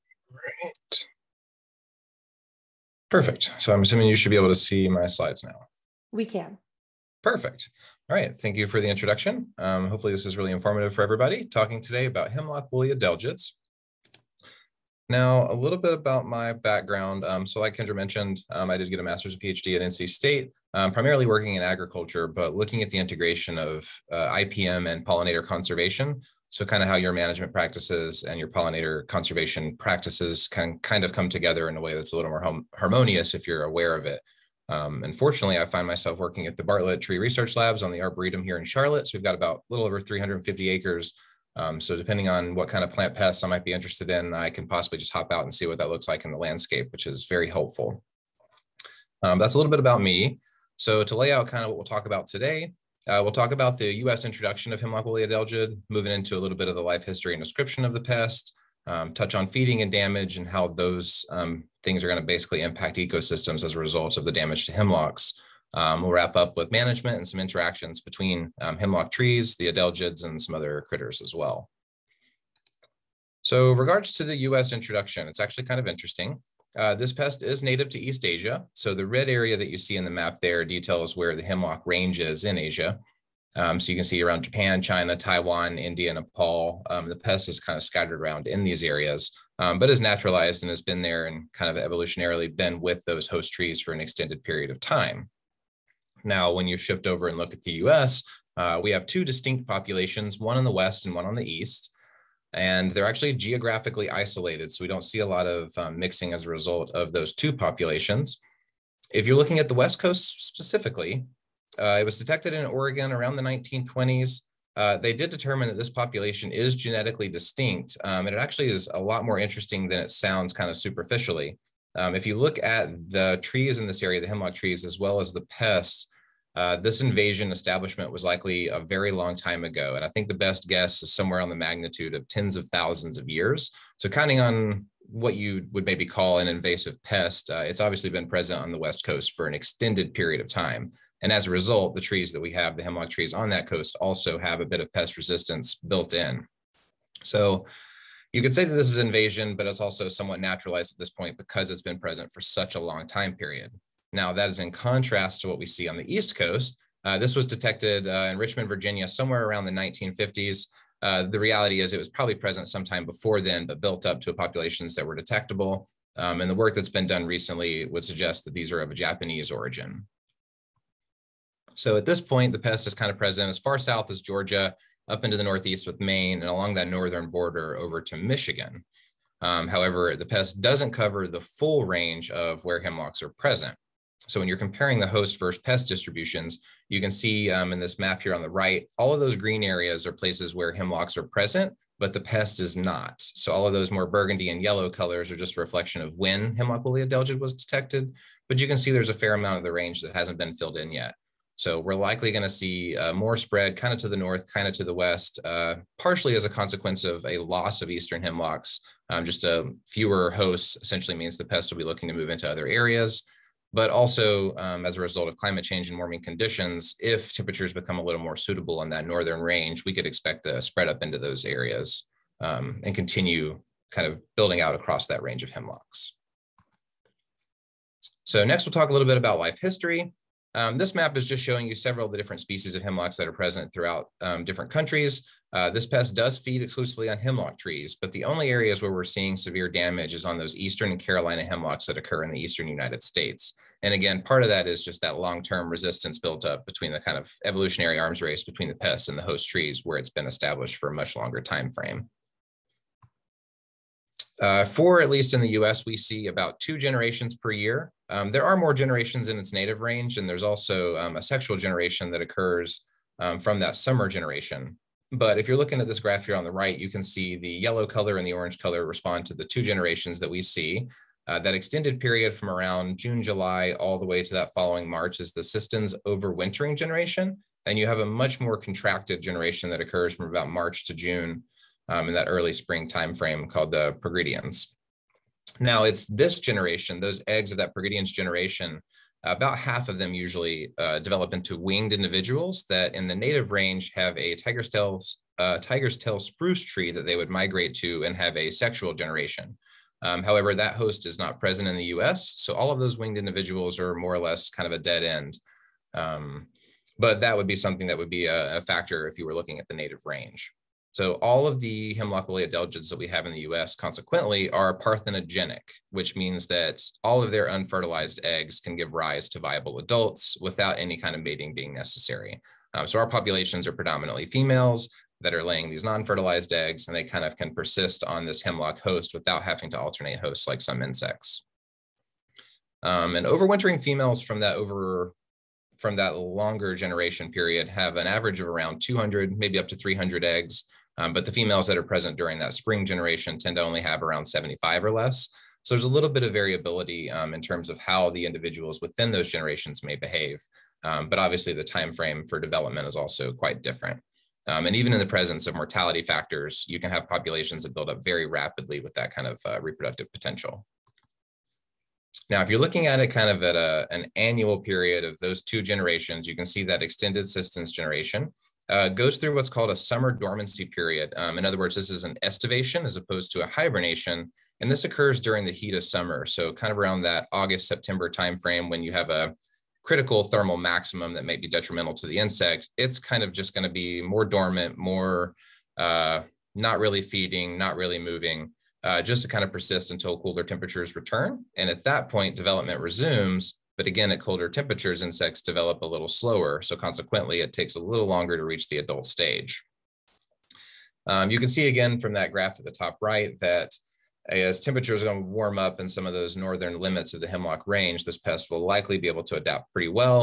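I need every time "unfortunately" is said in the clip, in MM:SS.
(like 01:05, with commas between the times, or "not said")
00:34.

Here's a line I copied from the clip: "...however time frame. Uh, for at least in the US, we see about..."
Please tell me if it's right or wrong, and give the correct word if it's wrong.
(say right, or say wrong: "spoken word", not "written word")
wrong: "longer", not "however".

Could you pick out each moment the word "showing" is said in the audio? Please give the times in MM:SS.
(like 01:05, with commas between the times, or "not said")
03:51.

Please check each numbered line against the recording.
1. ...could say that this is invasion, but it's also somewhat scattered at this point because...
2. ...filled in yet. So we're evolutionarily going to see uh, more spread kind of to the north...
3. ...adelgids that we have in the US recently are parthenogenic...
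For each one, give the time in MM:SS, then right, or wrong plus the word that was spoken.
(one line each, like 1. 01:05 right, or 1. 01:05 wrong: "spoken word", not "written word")
1. 02:28 wrong: "naturalized", not "scattered"
2. 03:20 wrong: "likely", not "evolutionarily"
3. 05:12 wrong: "consequently", not "recently".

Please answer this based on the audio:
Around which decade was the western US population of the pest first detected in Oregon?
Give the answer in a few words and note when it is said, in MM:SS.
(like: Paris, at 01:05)
1920s, at 01:53.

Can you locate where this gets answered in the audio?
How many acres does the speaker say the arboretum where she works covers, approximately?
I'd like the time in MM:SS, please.
00:40.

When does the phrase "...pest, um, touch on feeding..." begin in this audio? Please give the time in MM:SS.
00:58.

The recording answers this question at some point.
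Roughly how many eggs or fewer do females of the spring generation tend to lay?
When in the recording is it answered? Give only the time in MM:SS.
05:44.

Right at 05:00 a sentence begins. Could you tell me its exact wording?
Um, however, that host is not present in the US.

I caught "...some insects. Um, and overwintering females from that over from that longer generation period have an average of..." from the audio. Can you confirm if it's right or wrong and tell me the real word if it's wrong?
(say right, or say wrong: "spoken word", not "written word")
right.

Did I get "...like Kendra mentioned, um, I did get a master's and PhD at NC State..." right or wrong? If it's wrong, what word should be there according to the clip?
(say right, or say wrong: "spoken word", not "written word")
right.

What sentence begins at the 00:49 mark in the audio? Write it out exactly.
Um, that's a little bit about me.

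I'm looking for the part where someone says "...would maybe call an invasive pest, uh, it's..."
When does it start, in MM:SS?
02:15.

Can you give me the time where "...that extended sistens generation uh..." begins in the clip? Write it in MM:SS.
06:06.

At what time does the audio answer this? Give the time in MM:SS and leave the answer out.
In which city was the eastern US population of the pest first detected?
02:38.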